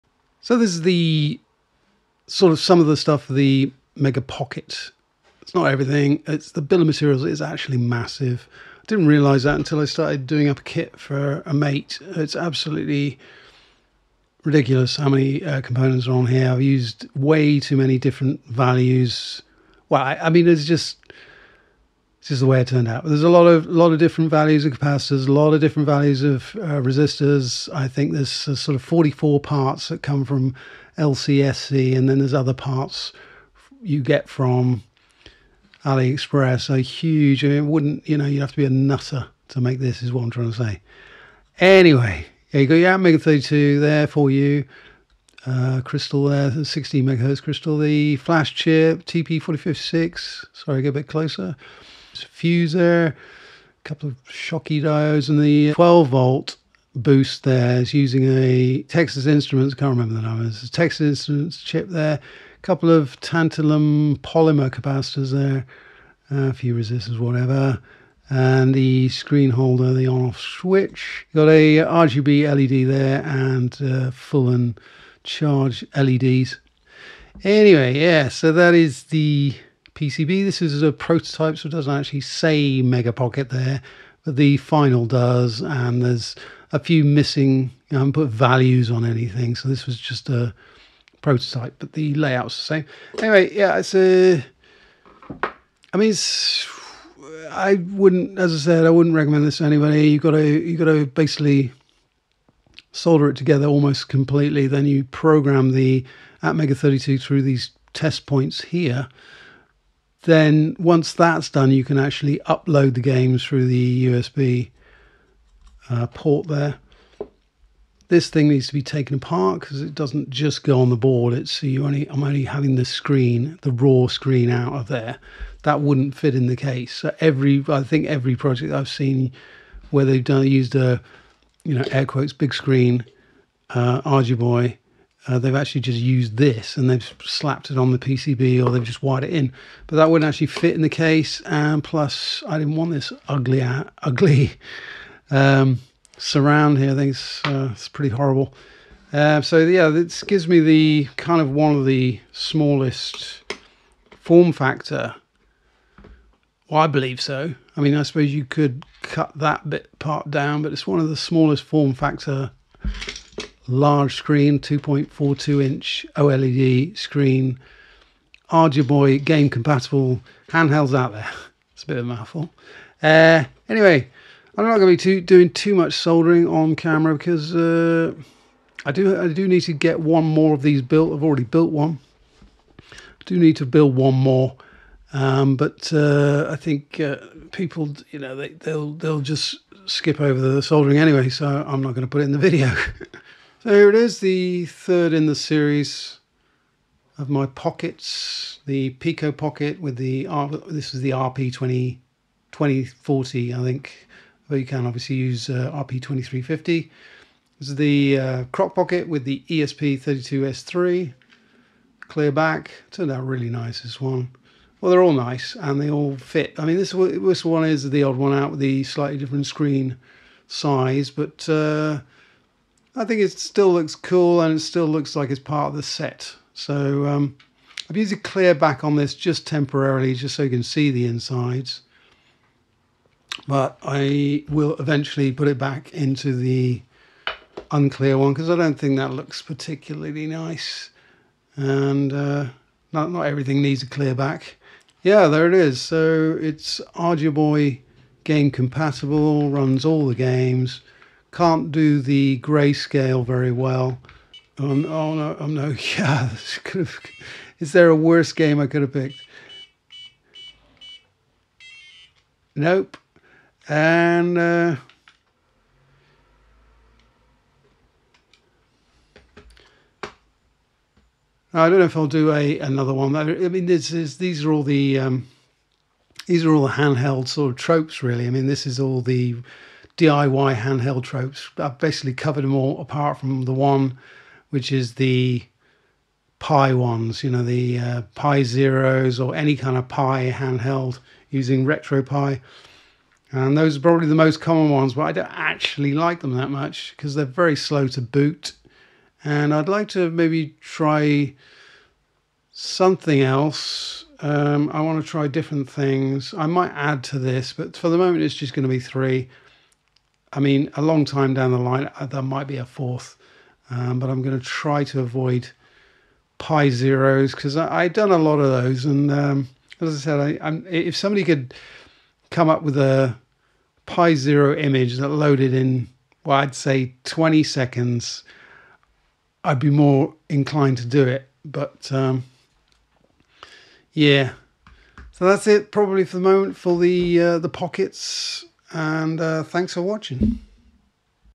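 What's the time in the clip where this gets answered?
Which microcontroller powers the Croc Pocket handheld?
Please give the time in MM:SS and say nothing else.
03:29.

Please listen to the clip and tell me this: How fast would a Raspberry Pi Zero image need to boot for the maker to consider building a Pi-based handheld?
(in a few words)
20 seconds.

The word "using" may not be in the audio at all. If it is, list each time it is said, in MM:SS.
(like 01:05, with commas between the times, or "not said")
00:57, 04:51.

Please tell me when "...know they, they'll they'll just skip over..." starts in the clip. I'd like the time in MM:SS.
03:08.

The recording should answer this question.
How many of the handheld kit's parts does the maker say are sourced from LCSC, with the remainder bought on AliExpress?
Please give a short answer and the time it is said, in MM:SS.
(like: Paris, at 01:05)
44, at 00:28.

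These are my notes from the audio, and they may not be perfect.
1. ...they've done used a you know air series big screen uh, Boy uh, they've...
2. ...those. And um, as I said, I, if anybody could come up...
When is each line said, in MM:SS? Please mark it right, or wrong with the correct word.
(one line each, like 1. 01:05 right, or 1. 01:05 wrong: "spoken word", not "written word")
1. 02:10 wrong: "quotes", not "series"
2. 05:18 wrong: "somebody", not "anybody".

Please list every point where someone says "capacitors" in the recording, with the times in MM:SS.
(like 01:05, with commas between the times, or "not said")
00:24, 01:04.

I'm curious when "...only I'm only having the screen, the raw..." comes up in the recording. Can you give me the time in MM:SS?
02:01.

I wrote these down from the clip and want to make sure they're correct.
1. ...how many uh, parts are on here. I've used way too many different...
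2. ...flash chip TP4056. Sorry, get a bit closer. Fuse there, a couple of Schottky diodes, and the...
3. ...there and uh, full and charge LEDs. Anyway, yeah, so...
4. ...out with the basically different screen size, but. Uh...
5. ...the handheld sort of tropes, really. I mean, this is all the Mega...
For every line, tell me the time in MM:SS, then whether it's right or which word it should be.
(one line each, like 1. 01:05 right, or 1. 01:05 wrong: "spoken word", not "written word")
1. 00:14 wrong: "components", not "parts"
2. 00:48 right
3. 01:12 right
4. 03:38 wrong: "slightly", not "basically"
5. 04:36 wrong: "DIY", not "Mega".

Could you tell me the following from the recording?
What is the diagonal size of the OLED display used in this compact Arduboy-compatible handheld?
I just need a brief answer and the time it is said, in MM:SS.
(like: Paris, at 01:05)
2.42 inch, at 02:44.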